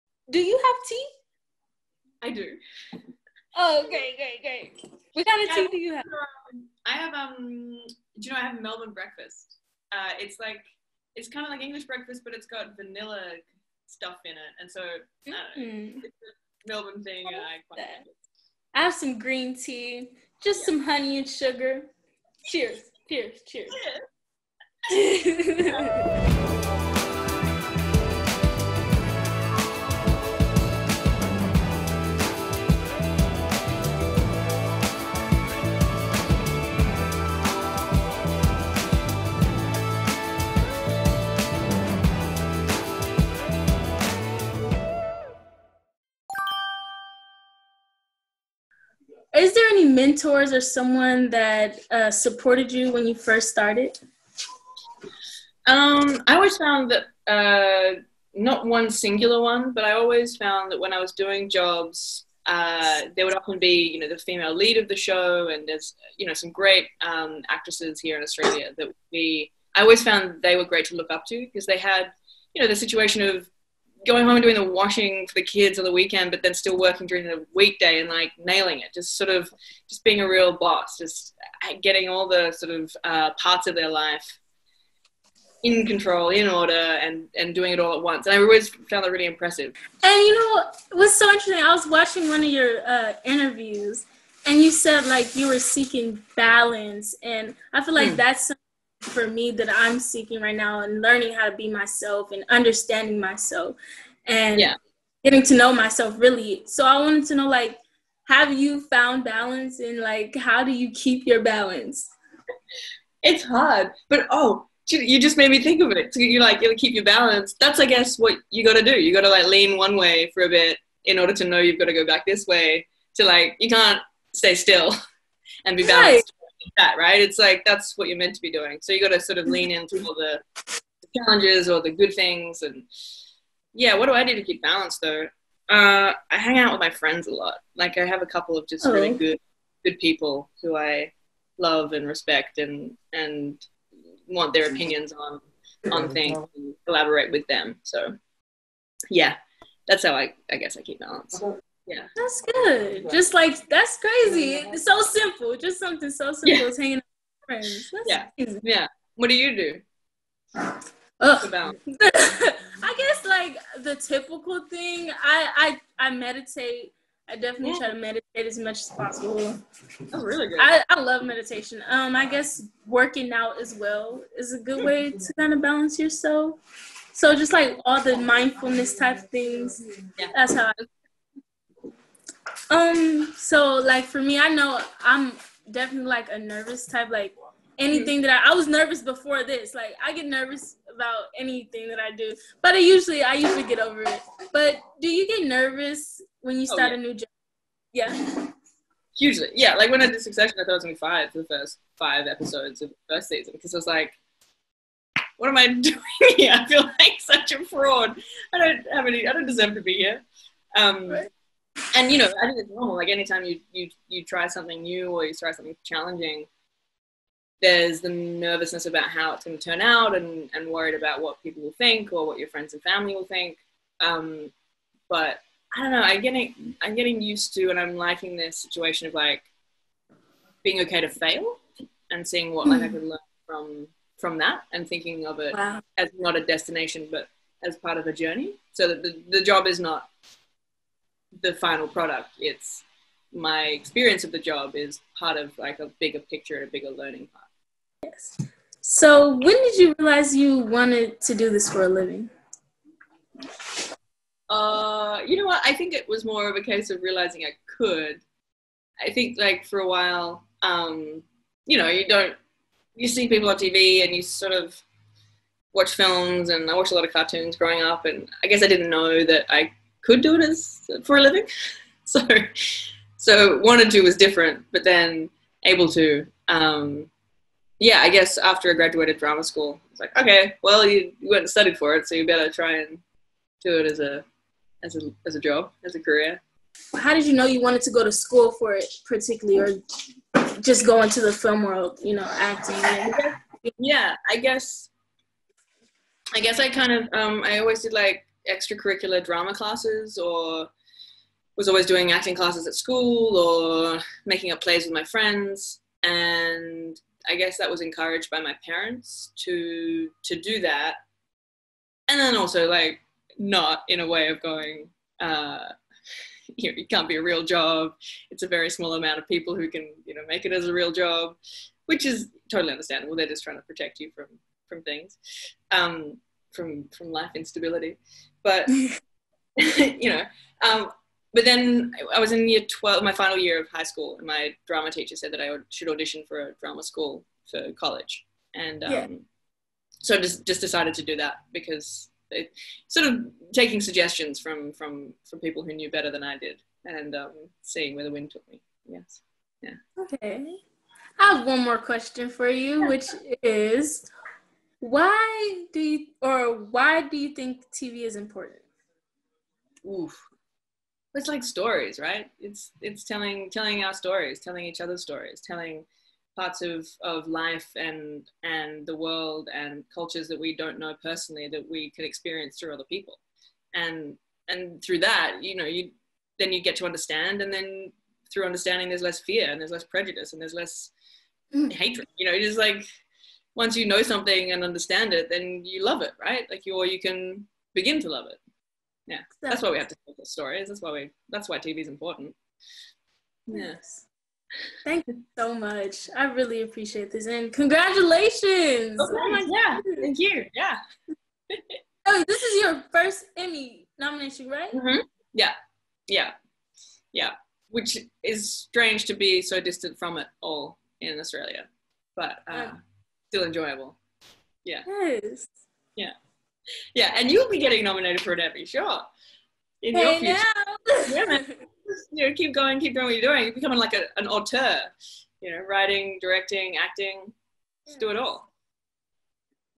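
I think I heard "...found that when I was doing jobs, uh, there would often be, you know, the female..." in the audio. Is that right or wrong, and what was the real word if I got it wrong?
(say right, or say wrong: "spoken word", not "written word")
right.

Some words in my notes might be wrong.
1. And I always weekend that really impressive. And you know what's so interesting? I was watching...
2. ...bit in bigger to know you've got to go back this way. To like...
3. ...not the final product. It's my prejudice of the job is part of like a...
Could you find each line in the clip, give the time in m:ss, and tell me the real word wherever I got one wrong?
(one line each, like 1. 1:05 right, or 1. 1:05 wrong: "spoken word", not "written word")
1. 1:28 wrong: "found", not "weekend"
2. 2:00 wrong: "order", not "bigger"
3. 3:59 wrong: "experience", not "prejudice".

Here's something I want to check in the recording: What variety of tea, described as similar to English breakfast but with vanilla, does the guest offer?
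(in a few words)
Melbourne breakfast.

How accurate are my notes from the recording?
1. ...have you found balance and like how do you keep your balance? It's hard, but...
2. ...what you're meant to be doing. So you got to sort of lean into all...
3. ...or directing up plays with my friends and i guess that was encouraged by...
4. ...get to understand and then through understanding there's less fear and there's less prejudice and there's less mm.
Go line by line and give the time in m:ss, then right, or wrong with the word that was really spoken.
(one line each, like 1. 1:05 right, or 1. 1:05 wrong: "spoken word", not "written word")
1. 1:48 right
2. 2:07 right
3. 5:03 wrong: "making", not "directing"
4. 6:16 right.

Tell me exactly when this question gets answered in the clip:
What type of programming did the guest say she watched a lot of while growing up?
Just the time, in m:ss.
4:27.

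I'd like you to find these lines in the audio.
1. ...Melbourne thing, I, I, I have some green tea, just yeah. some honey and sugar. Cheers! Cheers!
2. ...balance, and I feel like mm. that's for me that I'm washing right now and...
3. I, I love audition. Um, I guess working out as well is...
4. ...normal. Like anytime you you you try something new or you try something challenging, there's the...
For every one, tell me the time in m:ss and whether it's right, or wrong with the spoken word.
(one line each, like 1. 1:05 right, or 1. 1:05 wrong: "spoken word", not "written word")
1. 0:16 right
2. 1:36 wrong: "seeking", not "washing"
3. 2:50 wrong: "meditation", not "audition"
4. 3:32 right.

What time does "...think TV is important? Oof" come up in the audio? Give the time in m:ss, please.
5:57.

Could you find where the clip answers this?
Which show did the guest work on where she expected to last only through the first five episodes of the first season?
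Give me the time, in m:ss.
3:20.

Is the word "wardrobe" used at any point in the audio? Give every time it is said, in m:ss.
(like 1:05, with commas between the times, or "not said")
not said.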